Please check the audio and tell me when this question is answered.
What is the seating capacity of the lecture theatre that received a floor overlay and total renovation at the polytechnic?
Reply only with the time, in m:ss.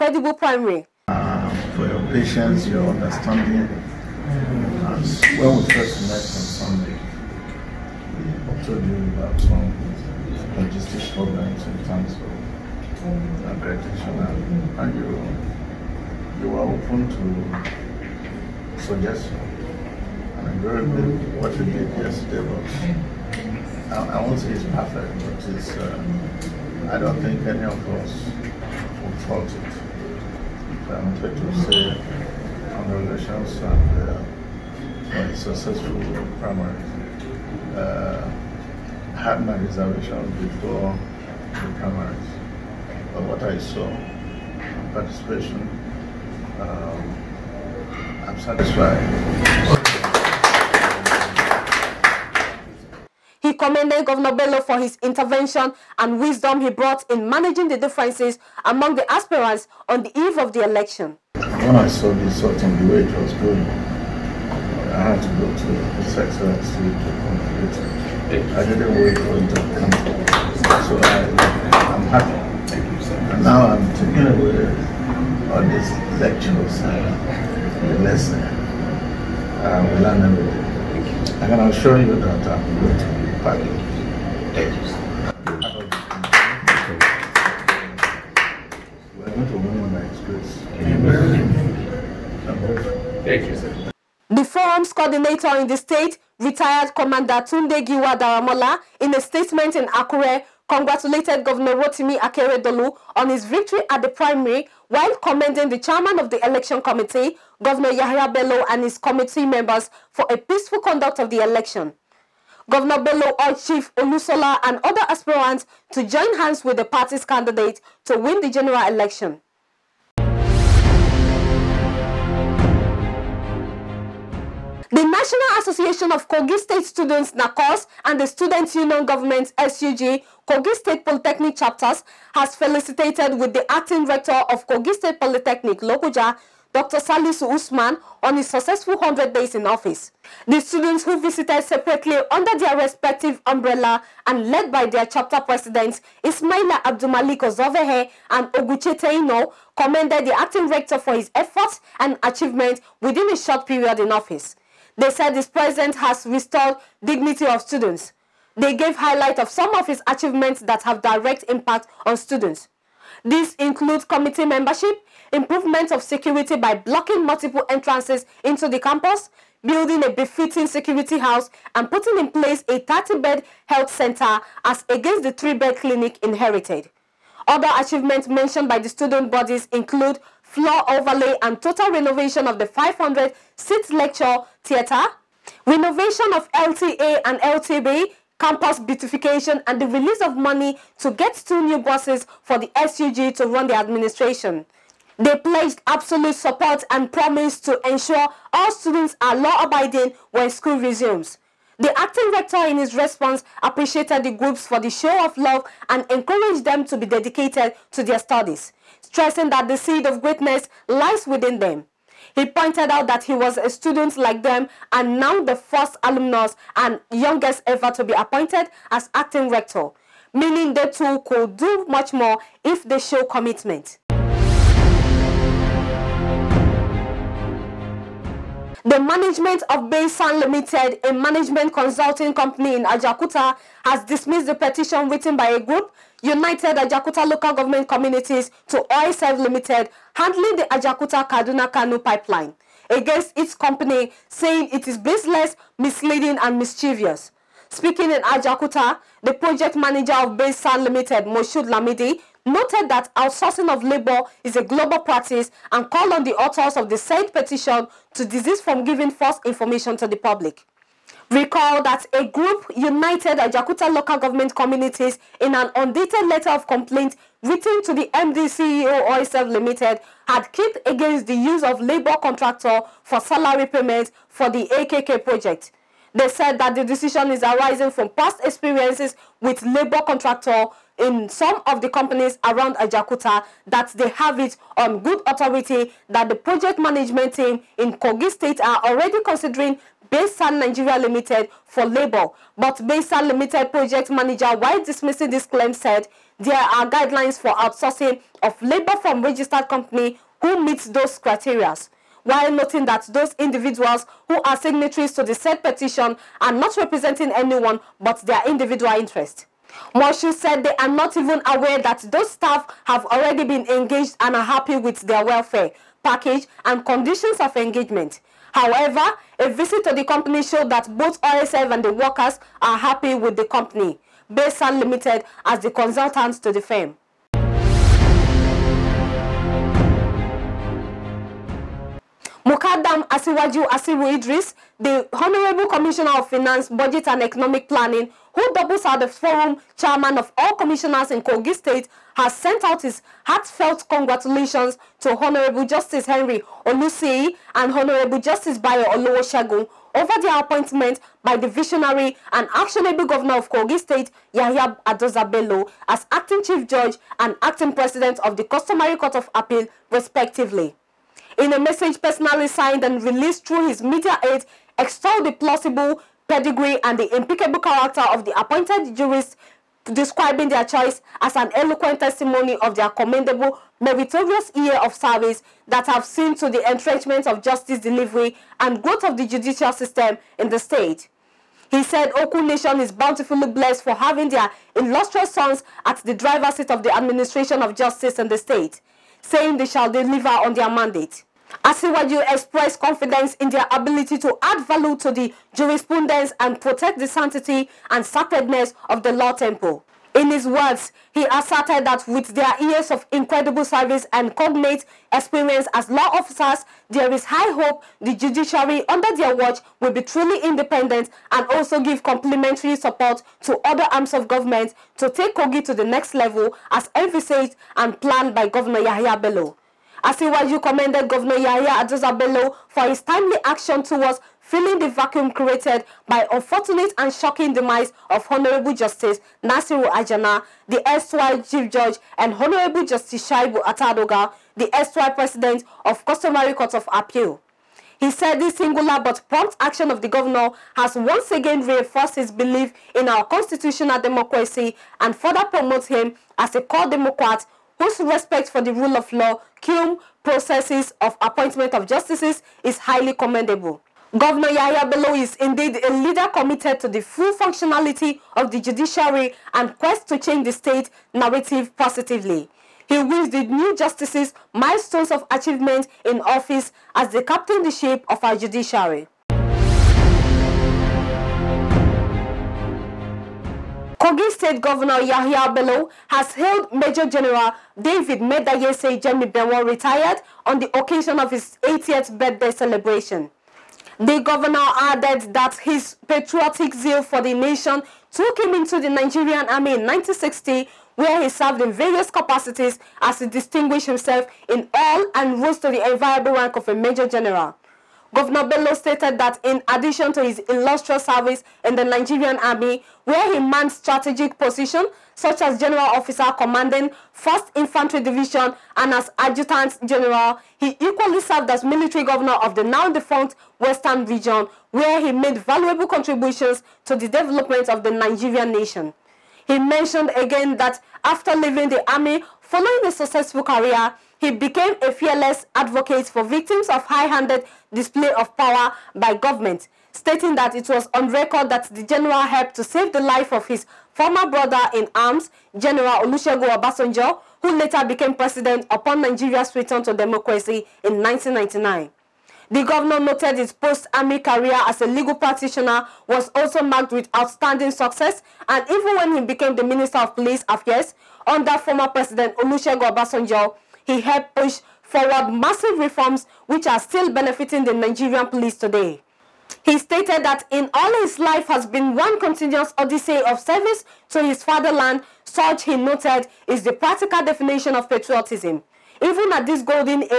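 3:02.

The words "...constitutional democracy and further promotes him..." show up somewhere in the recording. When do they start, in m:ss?
7:23.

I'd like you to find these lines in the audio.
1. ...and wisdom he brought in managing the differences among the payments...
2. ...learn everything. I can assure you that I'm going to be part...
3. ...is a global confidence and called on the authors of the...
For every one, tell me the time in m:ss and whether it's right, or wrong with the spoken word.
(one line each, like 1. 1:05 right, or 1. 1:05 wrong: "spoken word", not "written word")
1. 0:55 wrong: "aspirants", not "payments"
2. 1:20 right
3. 4:14 wrong: "practice", not "confidence".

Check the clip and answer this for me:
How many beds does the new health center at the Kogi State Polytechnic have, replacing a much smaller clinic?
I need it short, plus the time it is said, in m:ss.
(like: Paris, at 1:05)
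30, at 2:52.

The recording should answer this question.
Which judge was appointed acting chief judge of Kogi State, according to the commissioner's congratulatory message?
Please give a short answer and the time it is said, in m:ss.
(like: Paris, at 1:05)
Henry Olusiyi, at 5:45.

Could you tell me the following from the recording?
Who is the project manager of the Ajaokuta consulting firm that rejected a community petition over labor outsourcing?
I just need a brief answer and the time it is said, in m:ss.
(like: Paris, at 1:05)
Moshood Lamidi, at 4:11.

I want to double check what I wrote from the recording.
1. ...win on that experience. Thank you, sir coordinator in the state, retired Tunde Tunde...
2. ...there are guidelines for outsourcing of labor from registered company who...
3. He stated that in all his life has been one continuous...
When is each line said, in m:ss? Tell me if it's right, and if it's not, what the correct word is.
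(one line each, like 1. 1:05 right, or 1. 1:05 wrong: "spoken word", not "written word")
1. 1:29 wrong: "Commander", not "Tunde"
2. 4:56 right
3. 9:19 right.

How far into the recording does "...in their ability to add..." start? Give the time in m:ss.
6:33.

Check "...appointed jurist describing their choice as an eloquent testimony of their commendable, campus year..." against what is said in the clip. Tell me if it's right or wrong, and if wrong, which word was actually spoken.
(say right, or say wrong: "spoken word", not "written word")
wrong: "meritorious", not "campus".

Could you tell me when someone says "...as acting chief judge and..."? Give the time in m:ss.
5:55.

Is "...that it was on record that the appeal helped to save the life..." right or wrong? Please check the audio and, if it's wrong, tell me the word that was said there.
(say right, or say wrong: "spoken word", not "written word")
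wrong: "general", not "appeal".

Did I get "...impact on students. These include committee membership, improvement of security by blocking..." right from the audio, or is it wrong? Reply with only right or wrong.
right.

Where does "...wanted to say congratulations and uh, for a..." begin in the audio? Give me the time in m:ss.
0:31.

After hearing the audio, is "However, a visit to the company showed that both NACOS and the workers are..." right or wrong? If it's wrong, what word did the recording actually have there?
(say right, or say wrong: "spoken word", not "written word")
wrong: "OSF", not "NACOS".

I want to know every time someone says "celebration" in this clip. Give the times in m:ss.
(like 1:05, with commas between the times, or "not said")
8:02.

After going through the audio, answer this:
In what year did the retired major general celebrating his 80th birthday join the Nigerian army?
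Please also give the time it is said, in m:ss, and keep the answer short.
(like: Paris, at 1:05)
1960, at 8:09.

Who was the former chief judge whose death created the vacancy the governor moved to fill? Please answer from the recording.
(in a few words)
Nasiru Ajana.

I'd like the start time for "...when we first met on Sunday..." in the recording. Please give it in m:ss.
0:05.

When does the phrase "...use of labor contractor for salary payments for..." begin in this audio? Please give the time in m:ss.
4:31.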